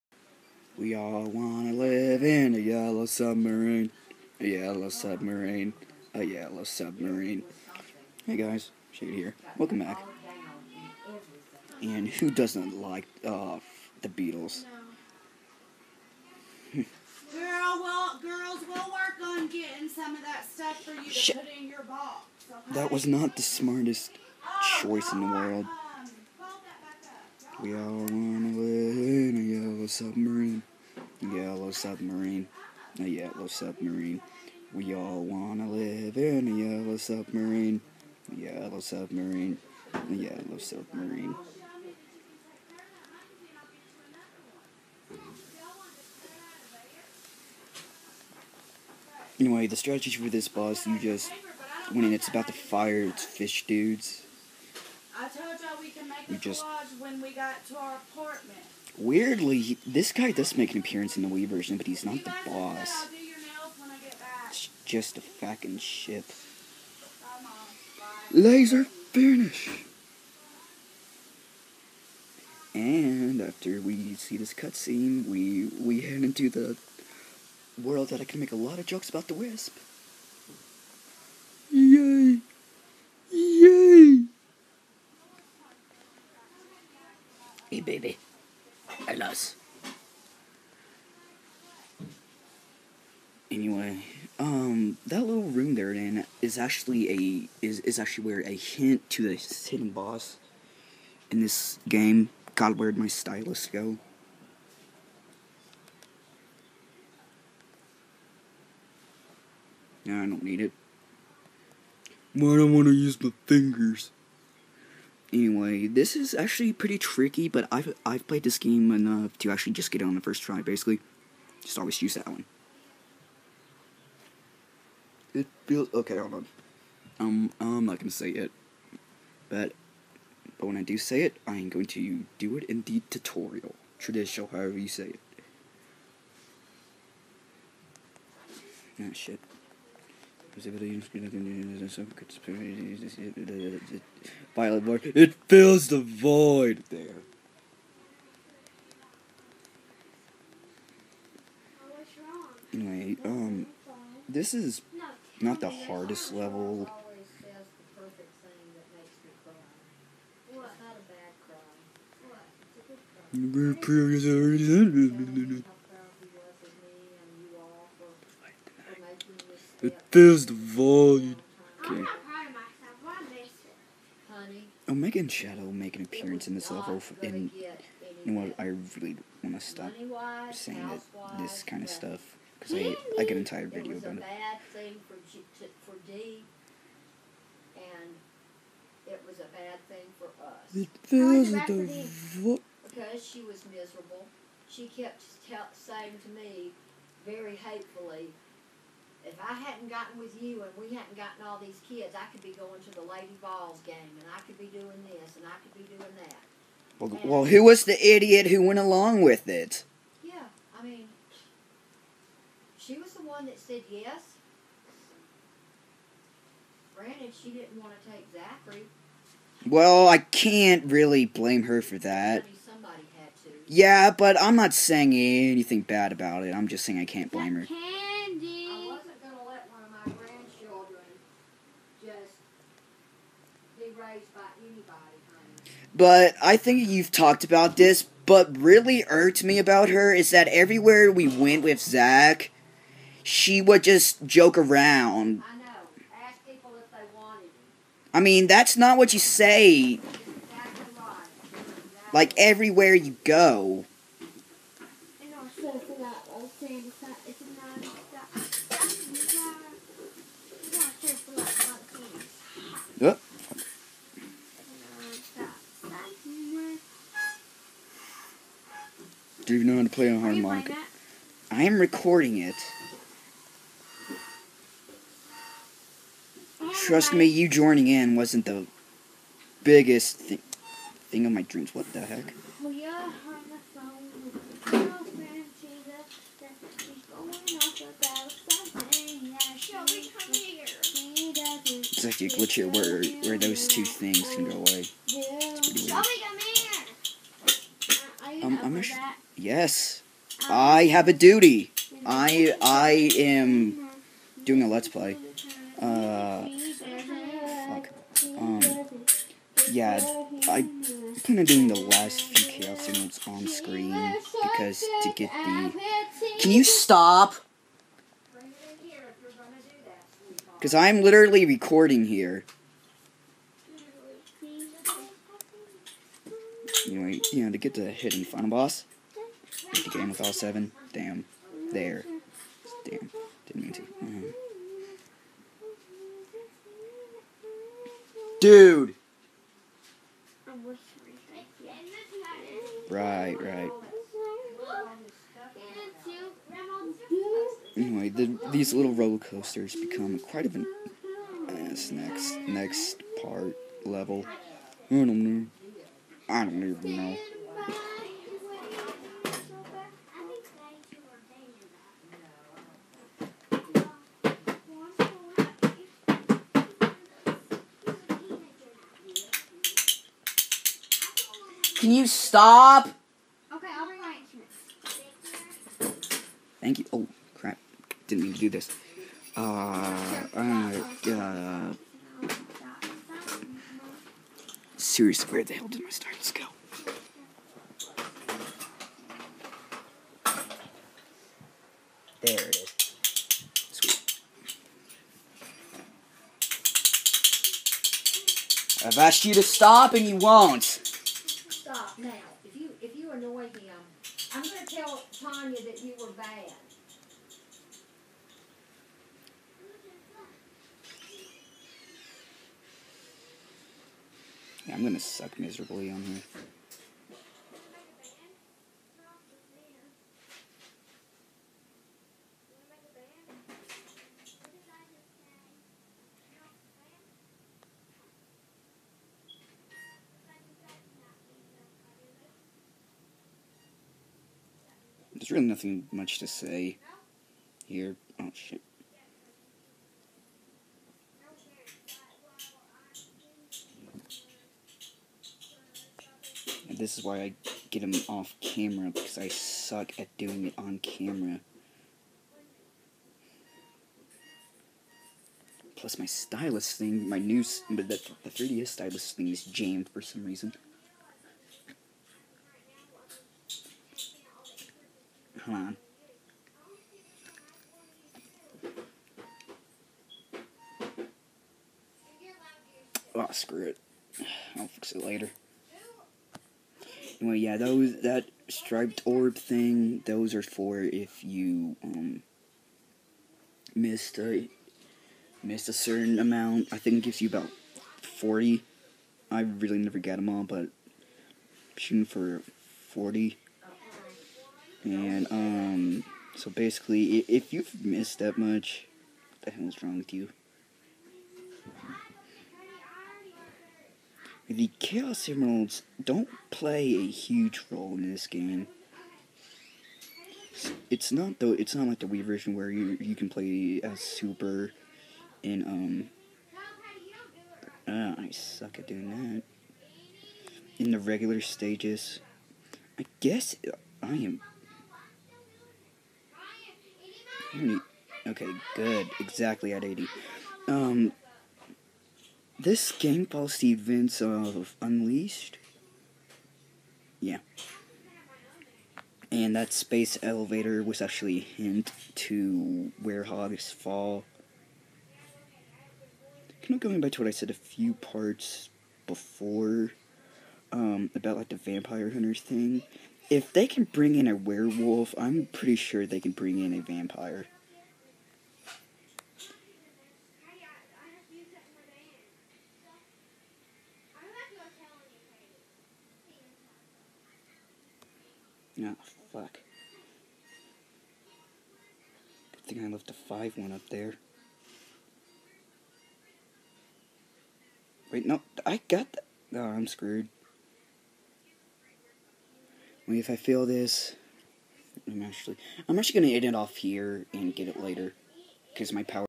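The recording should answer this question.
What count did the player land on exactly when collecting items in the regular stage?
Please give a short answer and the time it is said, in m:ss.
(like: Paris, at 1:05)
80, at 8:49.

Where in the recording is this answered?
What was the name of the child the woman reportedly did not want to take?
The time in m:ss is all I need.
3:38.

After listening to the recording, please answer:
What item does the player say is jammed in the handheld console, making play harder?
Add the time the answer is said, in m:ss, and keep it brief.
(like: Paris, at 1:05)
3DS stylus, at 7:38.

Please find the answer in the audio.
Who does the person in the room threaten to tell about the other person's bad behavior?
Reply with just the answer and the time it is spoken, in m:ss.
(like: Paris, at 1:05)
Tanya, at 6:45.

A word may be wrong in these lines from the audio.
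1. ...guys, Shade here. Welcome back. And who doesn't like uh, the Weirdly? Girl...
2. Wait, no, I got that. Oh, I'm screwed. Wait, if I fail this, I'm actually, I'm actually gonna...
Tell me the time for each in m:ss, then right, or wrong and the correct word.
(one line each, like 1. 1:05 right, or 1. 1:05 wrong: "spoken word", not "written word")
1. 0:08 wrong: "Beatles", not "Weirdly"
2. 9:38 right.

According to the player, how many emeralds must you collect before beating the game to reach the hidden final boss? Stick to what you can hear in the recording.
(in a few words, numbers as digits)
7.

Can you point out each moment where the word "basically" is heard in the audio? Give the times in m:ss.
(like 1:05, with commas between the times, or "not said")
2:00, 8:16.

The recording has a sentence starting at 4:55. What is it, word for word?
It's pretty weird um, I'm a sh- yes.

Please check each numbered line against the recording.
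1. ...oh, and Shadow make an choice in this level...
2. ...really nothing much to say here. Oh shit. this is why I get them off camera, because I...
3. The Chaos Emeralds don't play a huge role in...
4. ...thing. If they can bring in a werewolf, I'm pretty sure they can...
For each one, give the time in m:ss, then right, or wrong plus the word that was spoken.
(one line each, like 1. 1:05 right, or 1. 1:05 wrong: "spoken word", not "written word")
1. 2:55 wrong: "appearance", not "choice"
2. 7:15 right
3. 8:24 right
4. 9:12 right.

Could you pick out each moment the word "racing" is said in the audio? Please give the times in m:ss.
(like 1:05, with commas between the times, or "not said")
not said.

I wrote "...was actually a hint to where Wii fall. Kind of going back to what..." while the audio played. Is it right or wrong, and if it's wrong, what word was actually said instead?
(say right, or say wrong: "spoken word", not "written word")
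wrong: "Hogs", not "Wii".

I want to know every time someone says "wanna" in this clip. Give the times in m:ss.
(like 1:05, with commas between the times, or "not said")
0:01, 0:27, 0:35.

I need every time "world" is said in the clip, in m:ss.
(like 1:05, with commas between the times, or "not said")
0:25, 1:17.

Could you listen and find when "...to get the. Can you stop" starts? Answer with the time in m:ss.
5:14.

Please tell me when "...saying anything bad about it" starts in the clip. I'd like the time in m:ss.
3:44.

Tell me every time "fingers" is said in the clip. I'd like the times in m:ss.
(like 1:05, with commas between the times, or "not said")
1:53.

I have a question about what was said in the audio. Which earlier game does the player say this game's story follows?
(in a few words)
Unleashed.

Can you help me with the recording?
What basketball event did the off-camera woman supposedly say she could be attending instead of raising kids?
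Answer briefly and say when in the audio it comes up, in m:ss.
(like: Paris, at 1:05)
Lady Balls game, at 3:23.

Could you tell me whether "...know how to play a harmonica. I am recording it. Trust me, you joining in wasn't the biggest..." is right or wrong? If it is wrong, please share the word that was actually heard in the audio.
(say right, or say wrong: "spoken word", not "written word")
right.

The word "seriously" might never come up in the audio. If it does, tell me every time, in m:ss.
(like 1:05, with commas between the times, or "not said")
6:25.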